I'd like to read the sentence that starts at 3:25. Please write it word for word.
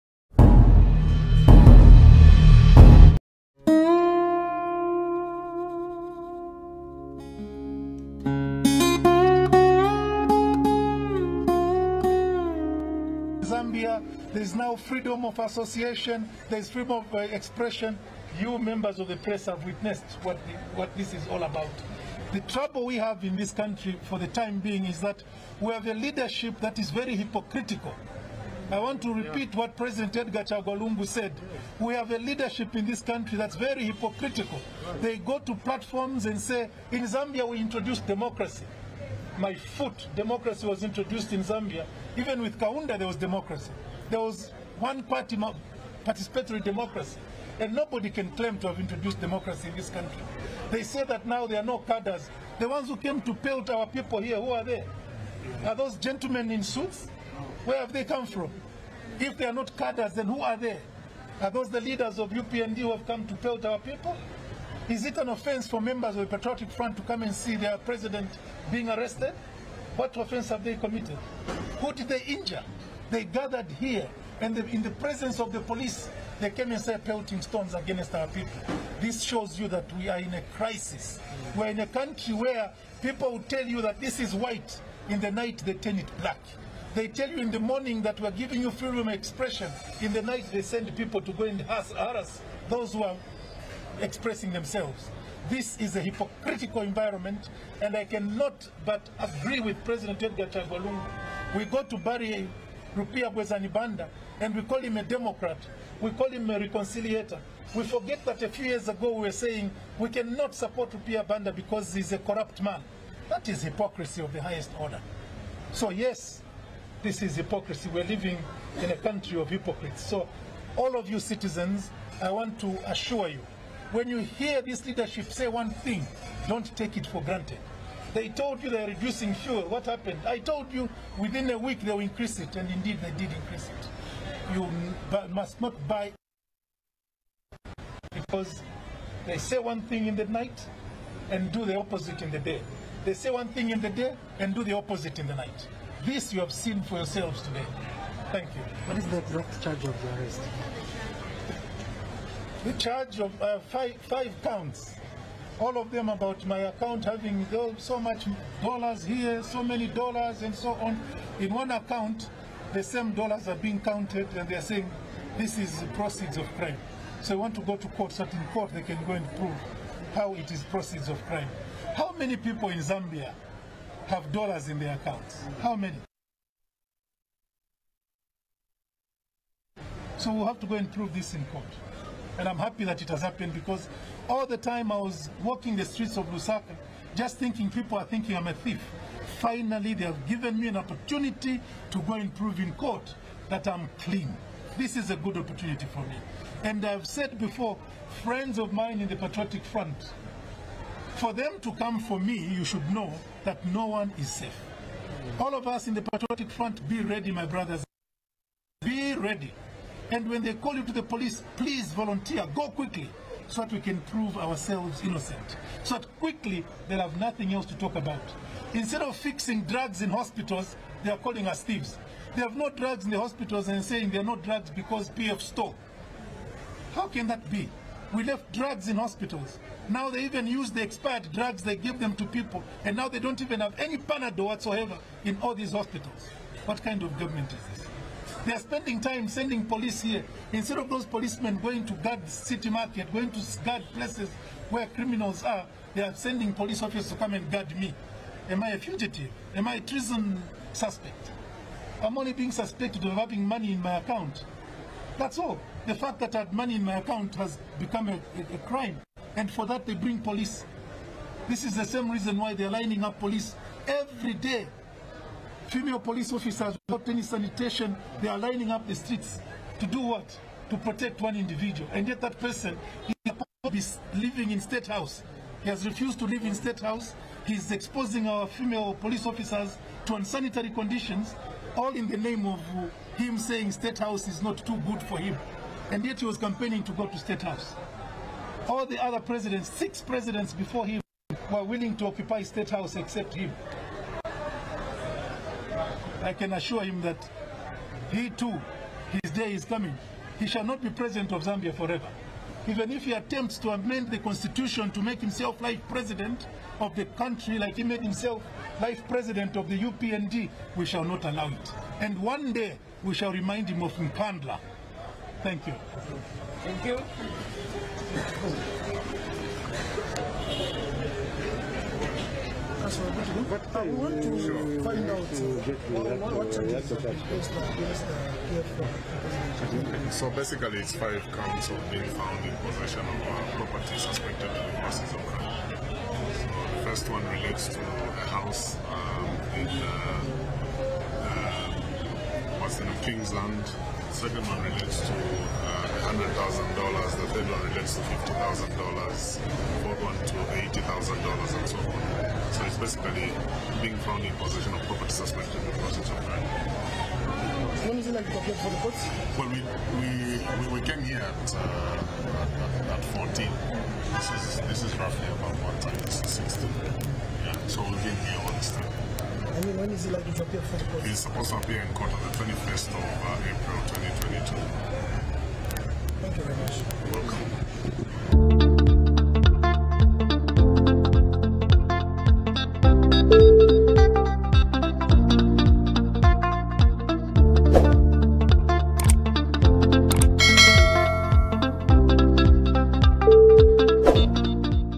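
All of us in the Patriotic Front, be ready, my brothers.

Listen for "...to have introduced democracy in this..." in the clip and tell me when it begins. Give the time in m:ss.
0:48.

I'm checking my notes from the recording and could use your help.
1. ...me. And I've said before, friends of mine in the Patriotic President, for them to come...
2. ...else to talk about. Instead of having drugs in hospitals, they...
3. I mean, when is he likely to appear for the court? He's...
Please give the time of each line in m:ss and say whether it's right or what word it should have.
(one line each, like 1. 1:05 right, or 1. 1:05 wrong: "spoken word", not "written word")
1. 3:15 wrong: "Front", not "President"
2. 3:37 wrong: "fixing", not "having"
3. 6:09 right.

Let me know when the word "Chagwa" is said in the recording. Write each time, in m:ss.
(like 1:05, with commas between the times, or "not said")
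0:30, 1:40.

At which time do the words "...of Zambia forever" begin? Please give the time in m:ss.
5:01.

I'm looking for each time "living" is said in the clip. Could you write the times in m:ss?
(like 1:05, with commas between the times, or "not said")
1:58, 4:34.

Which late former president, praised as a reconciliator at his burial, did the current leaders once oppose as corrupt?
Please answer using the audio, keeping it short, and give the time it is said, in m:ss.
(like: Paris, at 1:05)
Rupiah Bwezani Banda, at 1:42.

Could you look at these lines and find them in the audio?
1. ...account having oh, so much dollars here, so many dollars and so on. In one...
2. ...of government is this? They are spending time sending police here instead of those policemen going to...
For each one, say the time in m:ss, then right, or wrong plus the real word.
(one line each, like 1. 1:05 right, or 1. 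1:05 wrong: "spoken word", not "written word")
1. 2:36 right
2. 3:57 right.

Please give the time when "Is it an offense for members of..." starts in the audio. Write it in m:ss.
1:04.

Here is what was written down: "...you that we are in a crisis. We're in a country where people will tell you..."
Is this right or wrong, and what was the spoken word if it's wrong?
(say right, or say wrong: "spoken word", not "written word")
right.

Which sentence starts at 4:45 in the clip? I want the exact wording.
And yet he was campaigning to go to State House.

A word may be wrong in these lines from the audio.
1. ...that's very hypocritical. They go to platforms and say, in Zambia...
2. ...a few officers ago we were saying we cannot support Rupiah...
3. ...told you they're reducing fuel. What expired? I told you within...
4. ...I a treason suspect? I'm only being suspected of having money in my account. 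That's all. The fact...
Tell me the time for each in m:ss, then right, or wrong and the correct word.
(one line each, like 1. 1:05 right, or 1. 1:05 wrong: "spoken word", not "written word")
1. 0:33 right
2. 1:48 wrong: "years", not "officers"
3. 2:08 wrong: "happened", not "expired"
4. 4:09 right.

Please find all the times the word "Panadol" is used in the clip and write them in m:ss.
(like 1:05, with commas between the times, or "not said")
3:53.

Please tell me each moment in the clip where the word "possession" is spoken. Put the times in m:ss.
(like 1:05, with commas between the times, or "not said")
5:32, 5:54.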